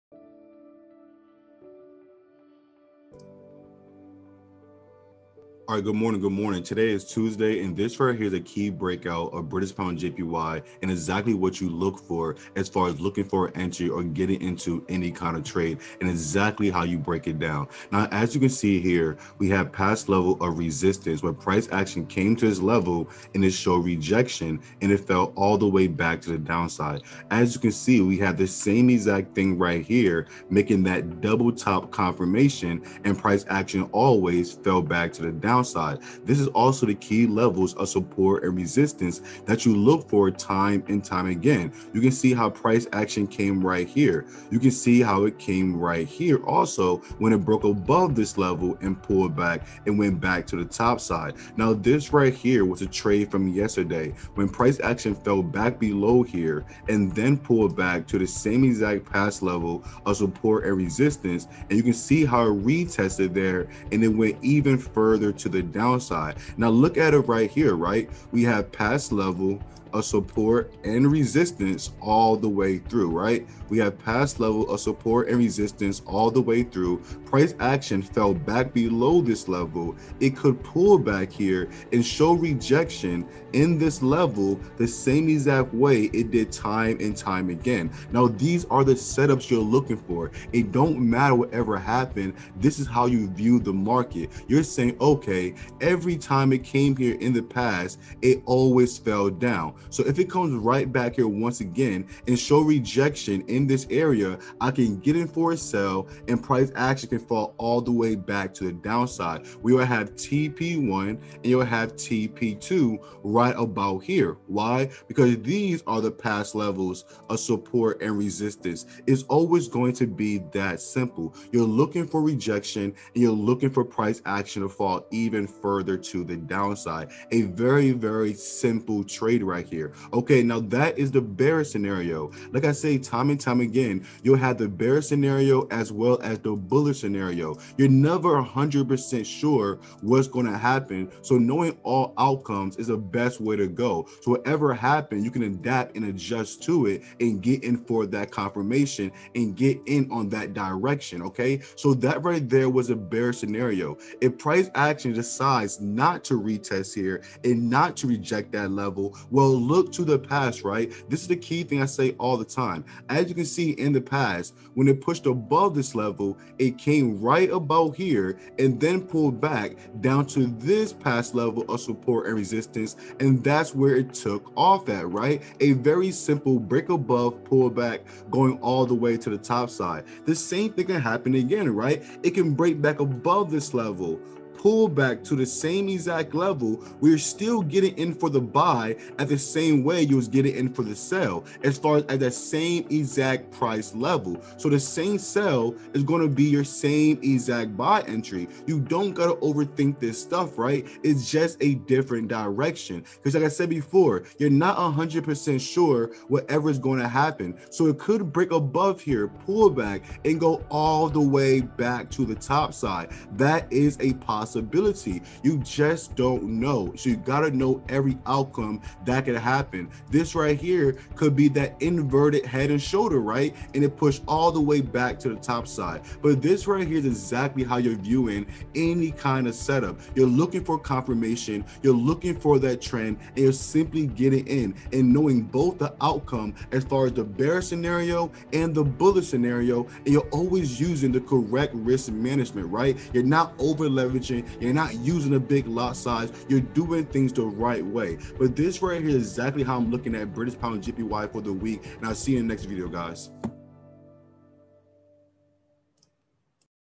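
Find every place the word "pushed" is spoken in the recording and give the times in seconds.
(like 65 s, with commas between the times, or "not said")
165 s, 223 s.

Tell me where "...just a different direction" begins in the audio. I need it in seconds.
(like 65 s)
201 s.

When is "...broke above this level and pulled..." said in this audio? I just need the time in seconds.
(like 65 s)
47 s.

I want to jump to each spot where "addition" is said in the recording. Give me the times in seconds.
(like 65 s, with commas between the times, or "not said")
not said.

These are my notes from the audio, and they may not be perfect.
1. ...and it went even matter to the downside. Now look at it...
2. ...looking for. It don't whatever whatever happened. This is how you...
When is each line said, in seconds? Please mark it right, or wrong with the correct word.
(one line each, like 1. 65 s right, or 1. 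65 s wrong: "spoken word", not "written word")
1. 63 s wrong: "further", not "matter"
2. 89 s wrong: "matter", not "whatever".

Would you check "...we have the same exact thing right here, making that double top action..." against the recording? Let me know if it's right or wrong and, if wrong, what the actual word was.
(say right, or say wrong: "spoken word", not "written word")
wrong: "confirmation", not "action".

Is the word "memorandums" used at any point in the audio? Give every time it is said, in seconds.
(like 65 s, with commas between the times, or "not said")
not said.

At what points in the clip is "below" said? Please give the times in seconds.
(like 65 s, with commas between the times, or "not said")
55 s, 78 s.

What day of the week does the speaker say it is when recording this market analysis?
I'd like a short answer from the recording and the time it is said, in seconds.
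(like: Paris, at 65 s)
Tuesday, at 7 s.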